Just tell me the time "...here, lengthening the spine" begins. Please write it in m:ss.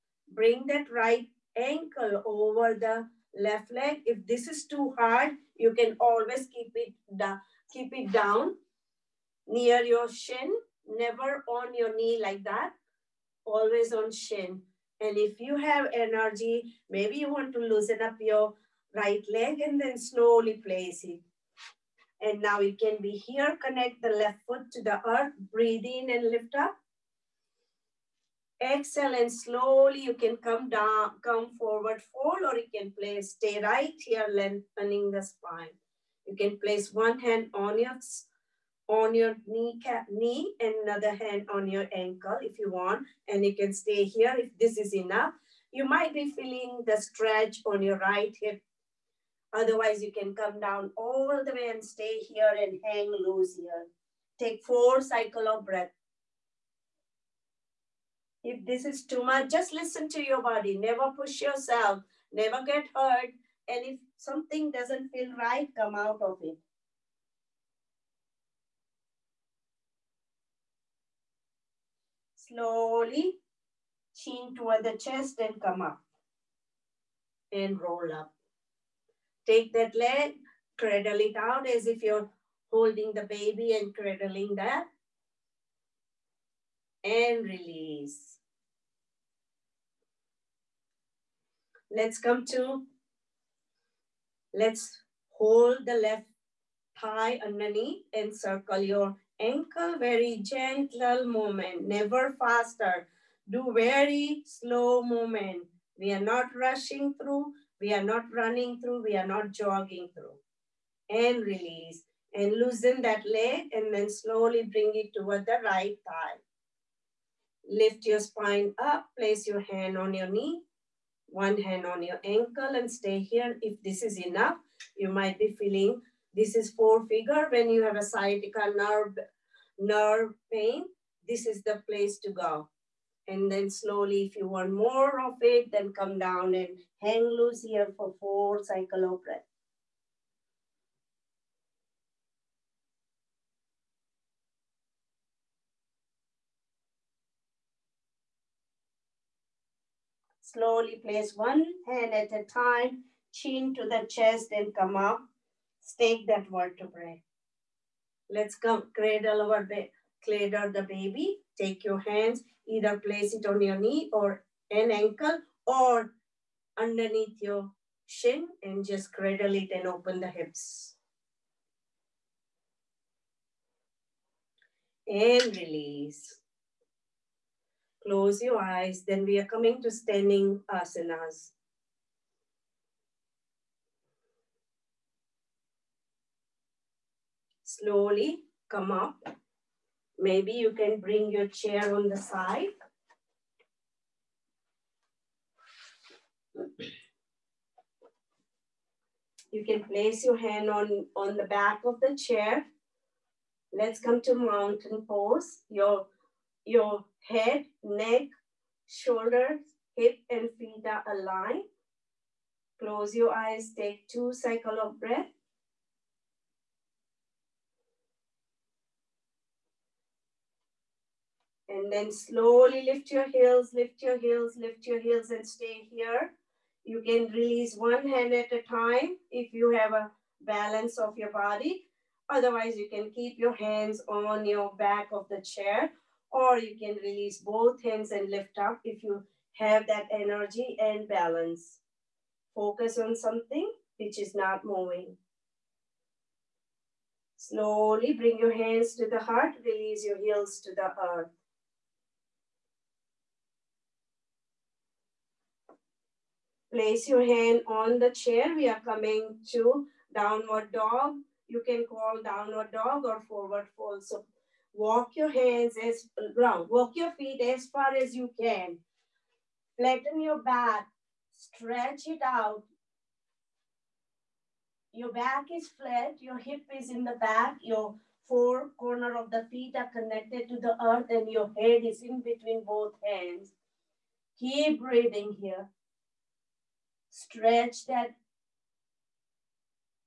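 0:34.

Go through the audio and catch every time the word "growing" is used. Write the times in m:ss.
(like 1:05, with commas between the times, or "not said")
not said.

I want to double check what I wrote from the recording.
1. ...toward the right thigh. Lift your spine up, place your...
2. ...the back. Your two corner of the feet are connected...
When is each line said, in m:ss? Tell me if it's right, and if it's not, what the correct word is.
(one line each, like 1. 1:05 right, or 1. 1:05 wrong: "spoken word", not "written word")
1. 1:55 right
2. 4:37 wrong: "four", not "two".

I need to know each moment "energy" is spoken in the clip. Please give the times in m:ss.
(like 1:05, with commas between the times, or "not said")
0:15, 4:00.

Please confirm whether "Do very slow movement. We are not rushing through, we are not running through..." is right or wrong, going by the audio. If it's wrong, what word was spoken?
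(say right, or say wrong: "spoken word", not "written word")
right.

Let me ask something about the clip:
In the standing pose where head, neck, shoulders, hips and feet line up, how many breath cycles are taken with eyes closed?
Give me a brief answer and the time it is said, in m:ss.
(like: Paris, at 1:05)
2, at 3:34.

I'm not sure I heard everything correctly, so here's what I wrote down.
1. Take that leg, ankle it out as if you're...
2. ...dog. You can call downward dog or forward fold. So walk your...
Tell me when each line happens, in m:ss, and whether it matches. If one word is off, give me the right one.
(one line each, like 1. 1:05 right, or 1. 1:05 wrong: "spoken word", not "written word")
1. 1:19 wrong: "cradle", not "ankle"
2. 4:20 right.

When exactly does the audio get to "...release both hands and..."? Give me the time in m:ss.
3:57.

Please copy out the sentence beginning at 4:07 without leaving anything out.
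Slowly bring your hands to the heart, release your heels to the earth.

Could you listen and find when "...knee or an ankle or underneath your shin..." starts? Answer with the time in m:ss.
2:43.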